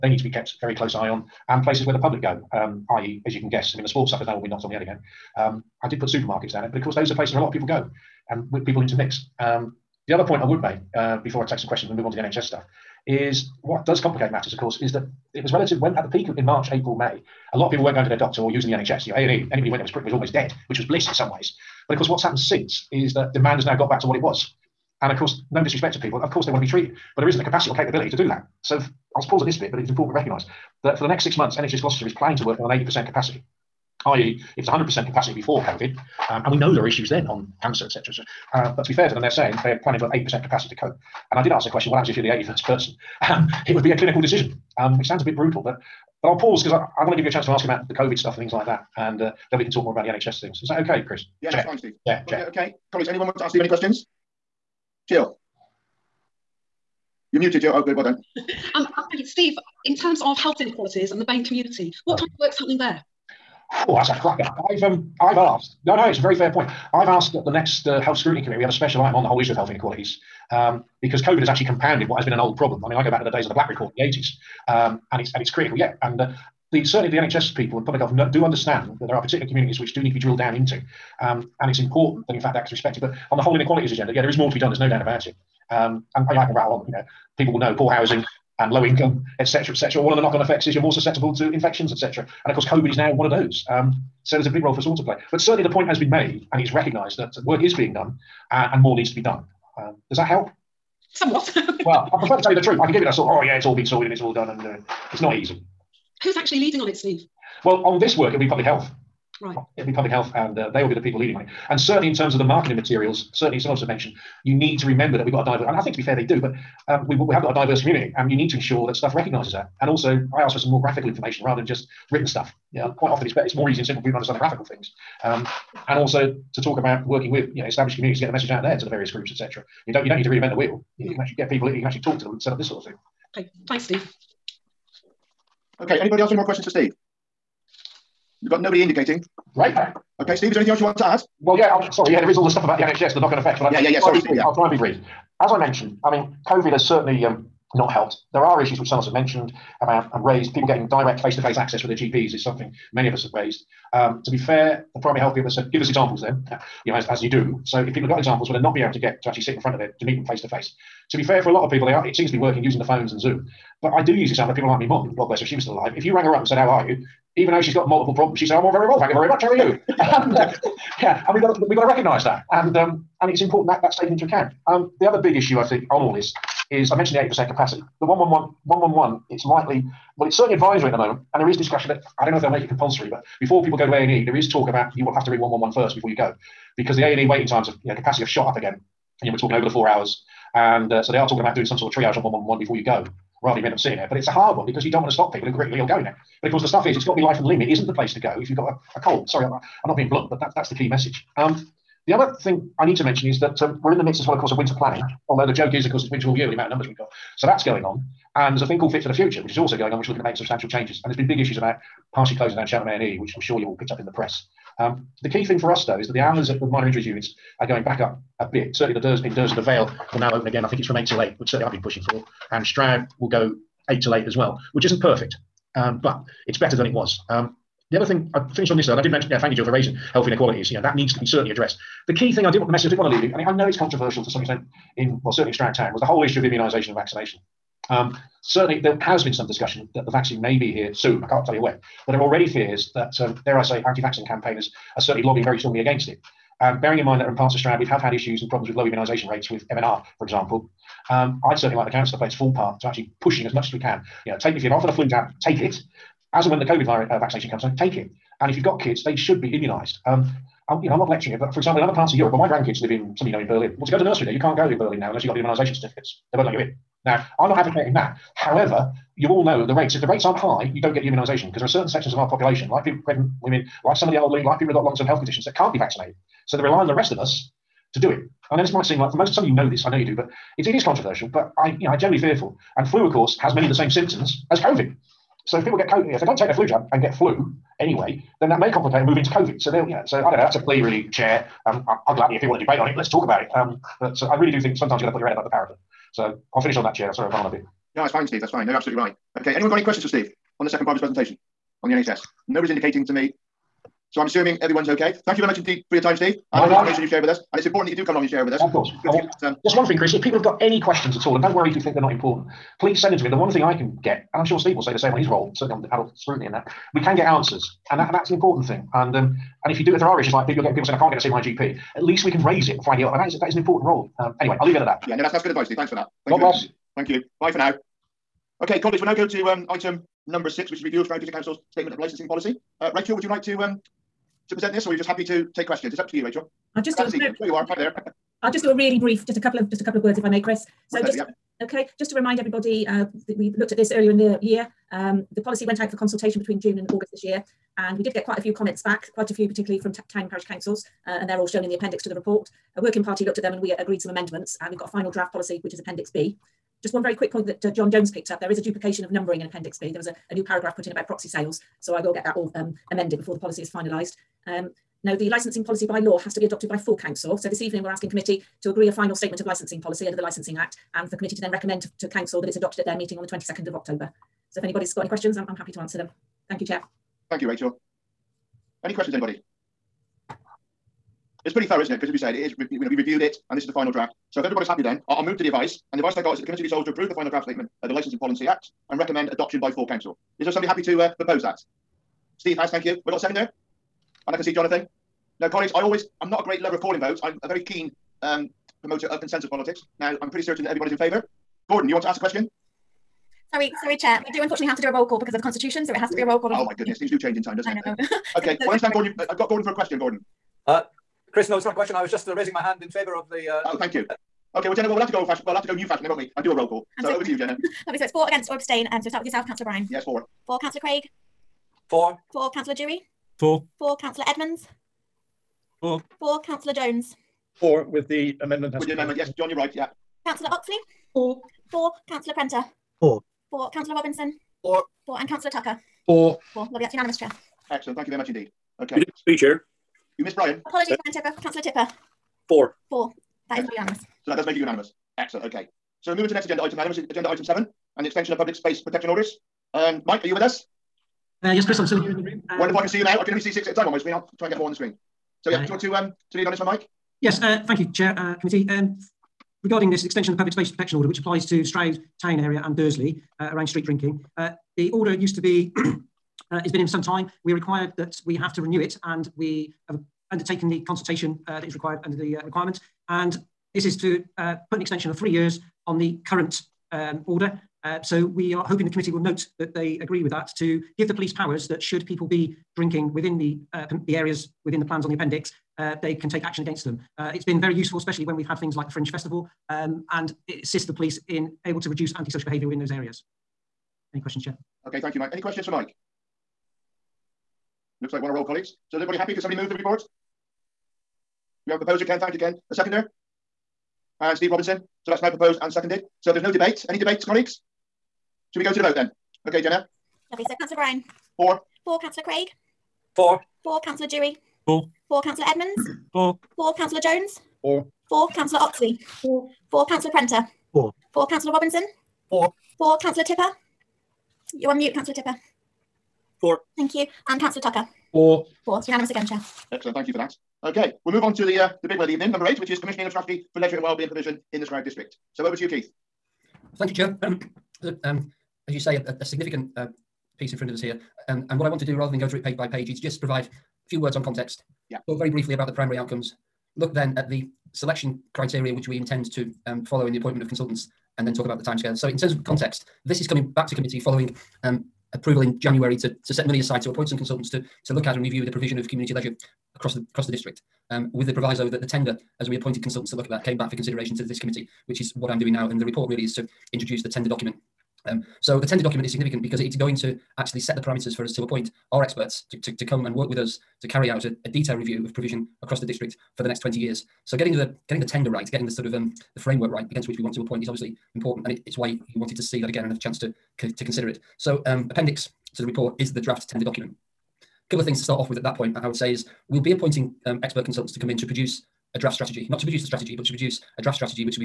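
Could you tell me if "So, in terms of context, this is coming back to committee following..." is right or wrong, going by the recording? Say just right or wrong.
right.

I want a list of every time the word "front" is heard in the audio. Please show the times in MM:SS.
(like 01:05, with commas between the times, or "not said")
02:39, 09:00.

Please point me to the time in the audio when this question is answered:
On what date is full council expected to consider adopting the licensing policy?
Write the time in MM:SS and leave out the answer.
06:13.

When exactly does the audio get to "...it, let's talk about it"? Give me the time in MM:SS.
04:52.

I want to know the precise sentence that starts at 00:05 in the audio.
Um, I did put supermarkets down it, but of course, those are places where a lot of people go and people intermix.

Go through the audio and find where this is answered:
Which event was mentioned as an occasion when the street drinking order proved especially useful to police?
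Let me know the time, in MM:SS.
08:08.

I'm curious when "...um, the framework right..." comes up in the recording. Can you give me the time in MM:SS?
09:38.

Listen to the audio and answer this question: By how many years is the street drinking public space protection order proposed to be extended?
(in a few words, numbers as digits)
3 years.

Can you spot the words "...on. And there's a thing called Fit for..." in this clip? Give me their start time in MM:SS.
03:27.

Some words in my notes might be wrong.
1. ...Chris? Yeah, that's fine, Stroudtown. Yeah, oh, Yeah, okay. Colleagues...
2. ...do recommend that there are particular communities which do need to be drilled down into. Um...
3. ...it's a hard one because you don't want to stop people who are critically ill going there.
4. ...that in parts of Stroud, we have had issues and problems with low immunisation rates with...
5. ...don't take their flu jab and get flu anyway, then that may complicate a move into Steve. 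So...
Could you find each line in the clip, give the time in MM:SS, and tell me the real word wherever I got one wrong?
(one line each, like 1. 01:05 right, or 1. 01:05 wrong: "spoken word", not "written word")
1. 00:51 wrong: "Steve", not "Stroudtown"
2. 01:18 wrong: "understand", not "recommend"
3. 03:14 right
4. 04:07 right
5. 04:46 wrong: "COVID", not "Steve".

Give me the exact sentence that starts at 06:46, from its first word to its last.
Oh my goodness, things do change in time, doesn't I it?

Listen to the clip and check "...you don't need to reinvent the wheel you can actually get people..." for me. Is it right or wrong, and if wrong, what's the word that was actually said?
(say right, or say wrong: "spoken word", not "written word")
right.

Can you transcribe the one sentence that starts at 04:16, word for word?
As and when the COVID virus, uh, vaccination comes on, take it.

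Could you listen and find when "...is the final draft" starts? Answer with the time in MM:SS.
06:23.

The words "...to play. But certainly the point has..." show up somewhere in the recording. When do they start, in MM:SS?
01:34.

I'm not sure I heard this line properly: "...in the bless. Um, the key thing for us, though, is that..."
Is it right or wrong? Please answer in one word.
wrong.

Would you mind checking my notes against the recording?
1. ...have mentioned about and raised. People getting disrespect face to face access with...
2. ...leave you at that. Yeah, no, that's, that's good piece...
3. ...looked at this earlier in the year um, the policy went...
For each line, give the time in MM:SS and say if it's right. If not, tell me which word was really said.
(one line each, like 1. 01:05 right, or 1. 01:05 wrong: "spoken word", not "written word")
1. 02:29 wrong: "direct", not "disrespect"
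2. 05:24 wrong: "advice", not "piece"
3. 05:43 right.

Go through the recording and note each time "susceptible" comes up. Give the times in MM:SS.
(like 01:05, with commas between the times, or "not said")
01:30.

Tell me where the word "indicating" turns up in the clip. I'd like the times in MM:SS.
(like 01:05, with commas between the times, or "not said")
02:18, 05:02.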